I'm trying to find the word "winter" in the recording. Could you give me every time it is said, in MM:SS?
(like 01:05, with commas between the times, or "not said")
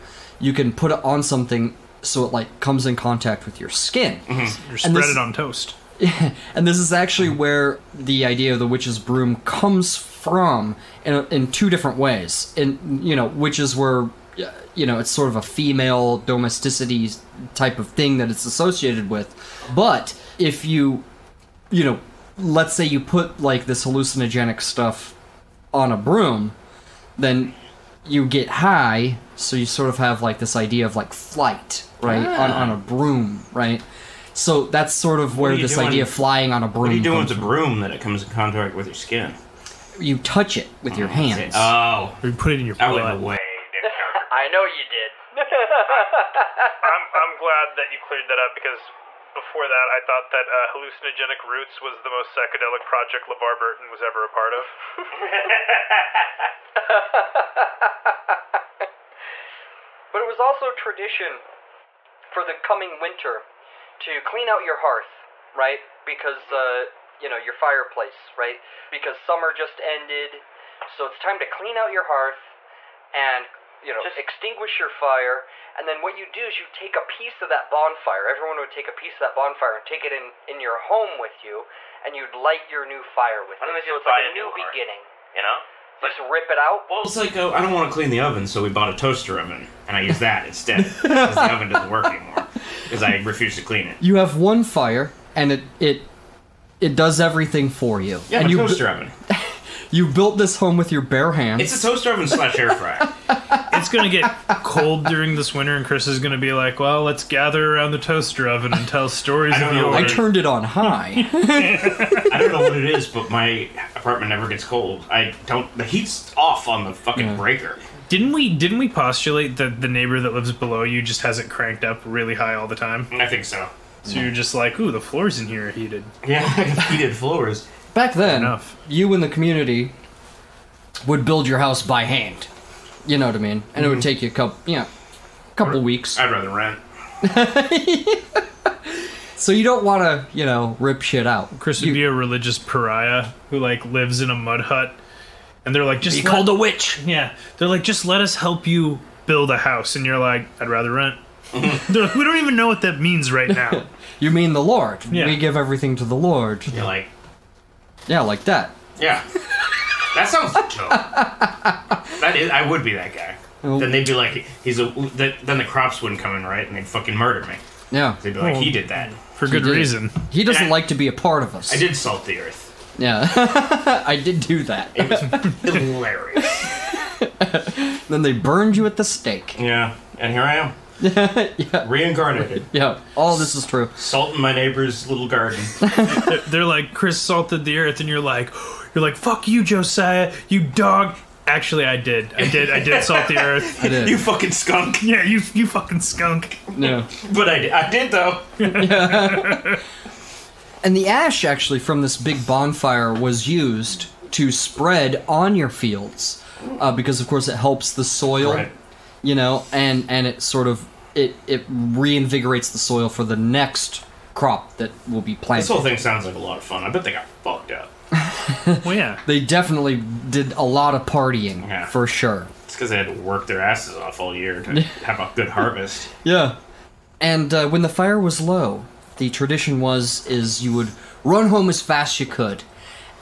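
01:03, 01:45.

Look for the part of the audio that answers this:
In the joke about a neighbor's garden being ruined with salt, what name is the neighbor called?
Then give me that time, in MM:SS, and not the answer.
03:09.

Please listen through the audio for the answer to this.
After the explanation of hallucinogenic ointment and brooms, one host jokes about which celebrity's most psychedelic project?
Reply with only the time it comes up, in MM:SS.
00:53.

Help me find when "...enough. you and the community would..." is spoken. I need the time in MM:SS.
02:08.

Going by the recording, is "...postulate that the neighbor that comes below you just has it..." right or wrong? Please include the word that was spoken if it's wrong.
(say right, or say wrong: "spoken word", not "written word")
wrong: "lives", not "comes".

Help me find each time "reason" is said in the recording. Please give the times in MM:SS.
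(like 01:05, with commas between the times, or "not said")
02:49.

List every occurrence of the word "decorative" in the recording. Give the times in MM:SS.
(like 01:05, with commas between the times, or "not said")
not said.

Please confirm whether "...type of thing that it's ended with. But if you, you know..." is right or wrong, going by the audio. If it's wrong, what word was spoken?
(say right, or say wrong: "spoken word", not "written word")
wrong: "associated", not "ended".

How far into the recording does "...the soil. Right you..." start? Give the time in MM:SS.
03:27.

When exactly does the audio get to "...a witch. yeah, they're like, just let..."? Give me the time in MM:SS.
02:26.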